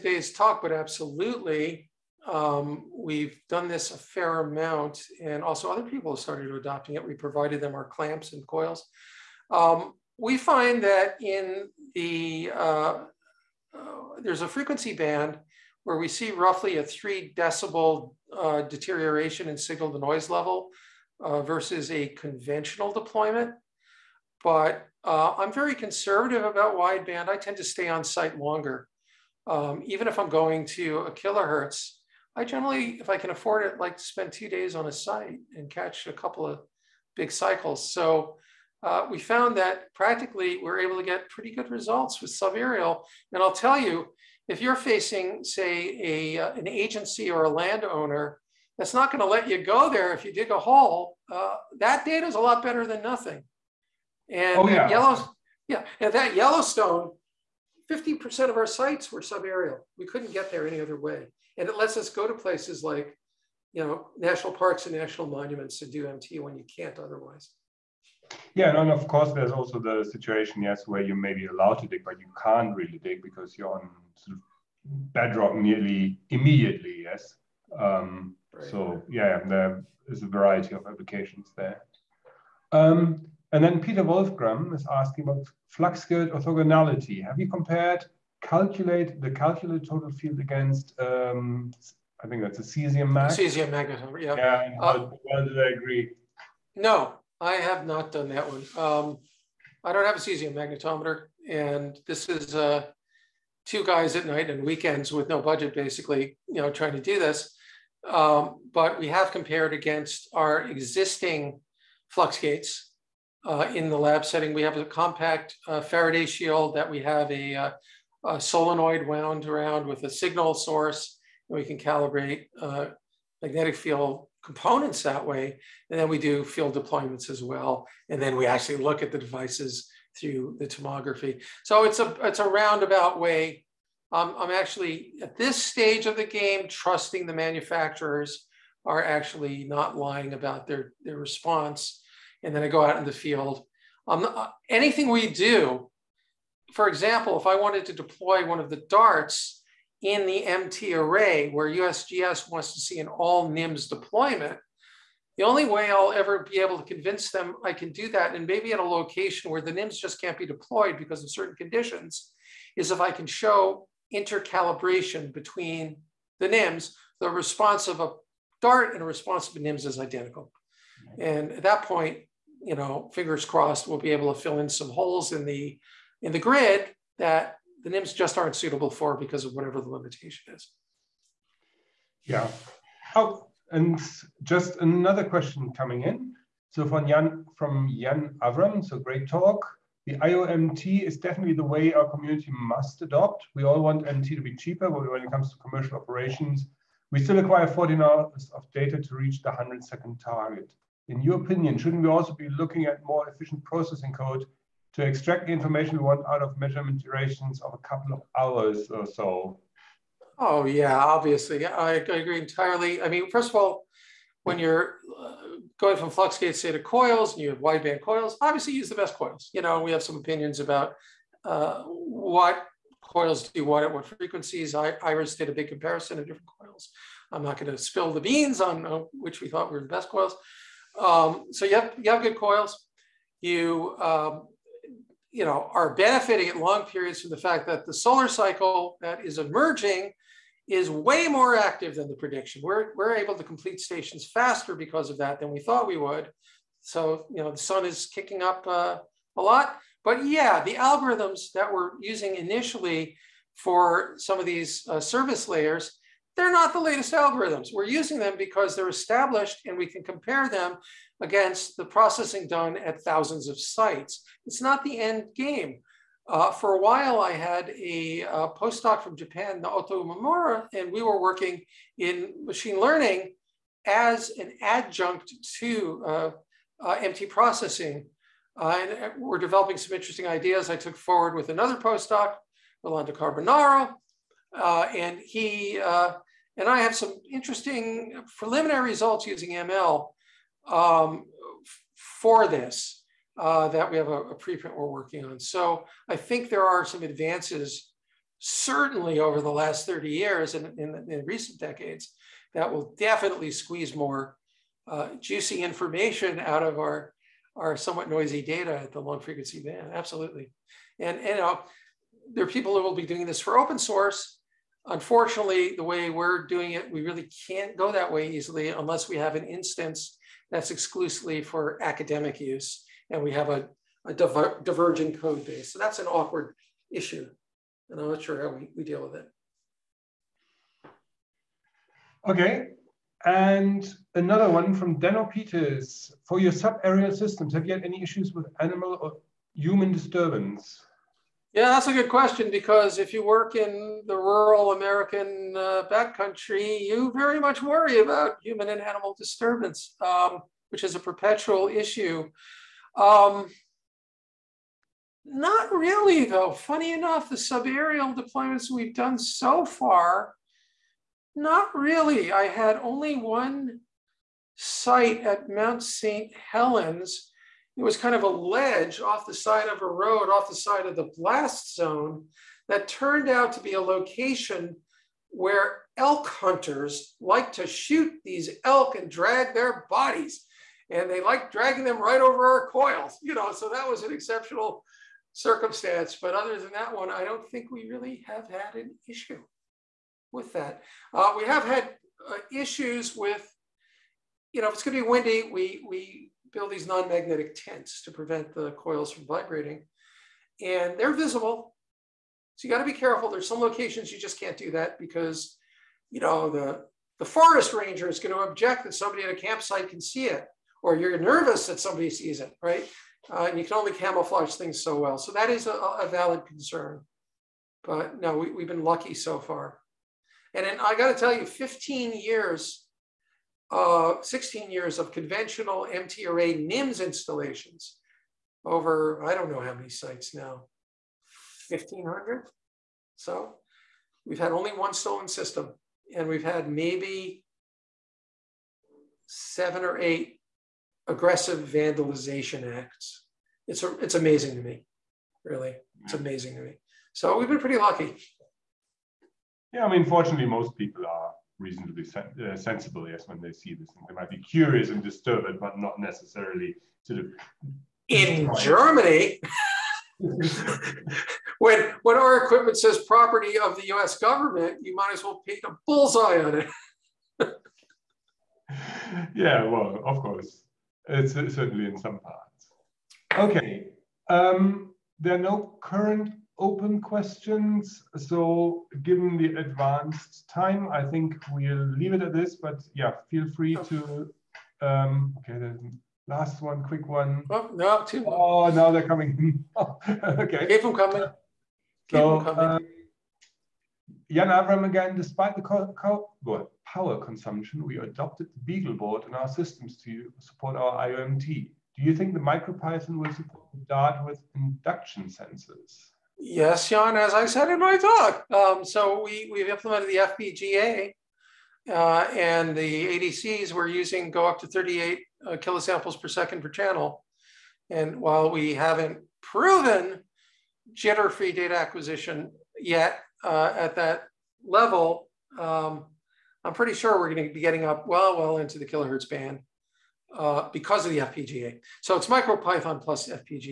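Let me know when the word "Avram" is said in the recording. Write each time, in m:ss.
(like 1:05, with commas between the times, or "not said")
3:08, 8:14.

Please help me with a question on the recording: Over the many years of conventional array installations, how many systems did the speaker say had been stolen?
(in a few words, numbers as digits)
1.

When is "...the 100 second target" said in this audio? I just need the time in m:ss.
3:19.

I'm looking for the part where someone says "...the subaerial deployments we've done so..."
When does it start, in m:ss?
5:57.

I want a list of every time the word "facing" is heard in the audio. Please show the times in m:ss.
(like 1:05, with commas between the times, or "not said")
0:44.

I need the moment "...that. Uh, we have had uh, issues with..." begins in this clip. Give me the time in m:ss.
6:30.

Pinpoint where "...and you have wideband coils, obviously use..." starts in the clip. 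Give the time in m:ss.
3:37.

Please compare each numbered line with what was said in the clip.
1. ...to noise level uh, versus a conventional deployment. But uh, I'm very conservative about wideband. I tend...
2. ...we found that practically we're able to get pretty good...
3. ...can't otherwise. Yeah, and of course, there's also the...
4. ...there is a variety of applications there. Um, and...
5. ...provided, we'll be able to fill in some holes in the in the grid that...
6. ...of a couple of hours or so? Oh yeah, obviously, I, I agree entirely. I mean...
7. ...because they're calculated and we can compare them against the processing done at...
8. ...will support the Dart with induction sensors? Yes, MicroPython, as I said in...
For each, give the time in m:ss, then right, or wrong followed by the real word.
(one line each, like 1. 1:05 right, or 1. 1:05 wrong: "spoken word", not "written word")
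1. 0:19 right
2. 0:39 right
3. 1:06 right
4. 1:19 right
5. 2:53 wrong: "crossed", not "provided"
6. 3:27 right
7. 4:18 wrong: "established", not "calculated"
8. 8:23 wrong: "Jan", not "MicroPython".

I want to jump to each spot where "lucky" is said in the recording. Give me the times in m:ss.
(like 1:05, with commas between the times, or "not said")
6:58, 7:27.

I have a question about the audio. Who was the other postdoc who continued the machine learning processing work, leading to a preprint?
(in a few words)
Rolando Carbonaro.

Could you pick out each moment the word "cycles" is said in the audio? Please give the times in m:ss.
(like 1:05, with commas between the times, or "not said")
0:37, 3:58.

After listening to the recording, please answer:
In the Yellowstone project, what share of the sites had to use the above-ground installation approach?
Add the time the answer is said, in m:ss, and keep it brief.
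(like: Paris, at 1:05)
50%, at 0:57.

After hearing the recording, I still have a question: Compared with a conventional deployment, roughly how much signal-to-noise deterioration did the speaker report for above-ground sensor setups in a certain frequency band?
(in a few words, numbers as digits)
3 decibels.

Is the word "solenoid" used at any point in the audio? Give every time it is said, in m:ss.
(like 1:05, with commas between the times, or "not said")
1:58.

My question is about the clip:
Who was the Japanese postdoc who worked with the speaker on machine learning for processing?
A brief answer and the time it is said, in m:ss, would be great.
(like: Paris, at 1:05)
Naoto Mamura, at 4:29.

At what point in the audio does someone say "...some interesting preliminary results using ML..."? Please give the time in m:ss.
4:46.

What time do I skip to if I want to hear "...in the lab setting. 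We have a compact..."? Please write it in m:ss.
1:53.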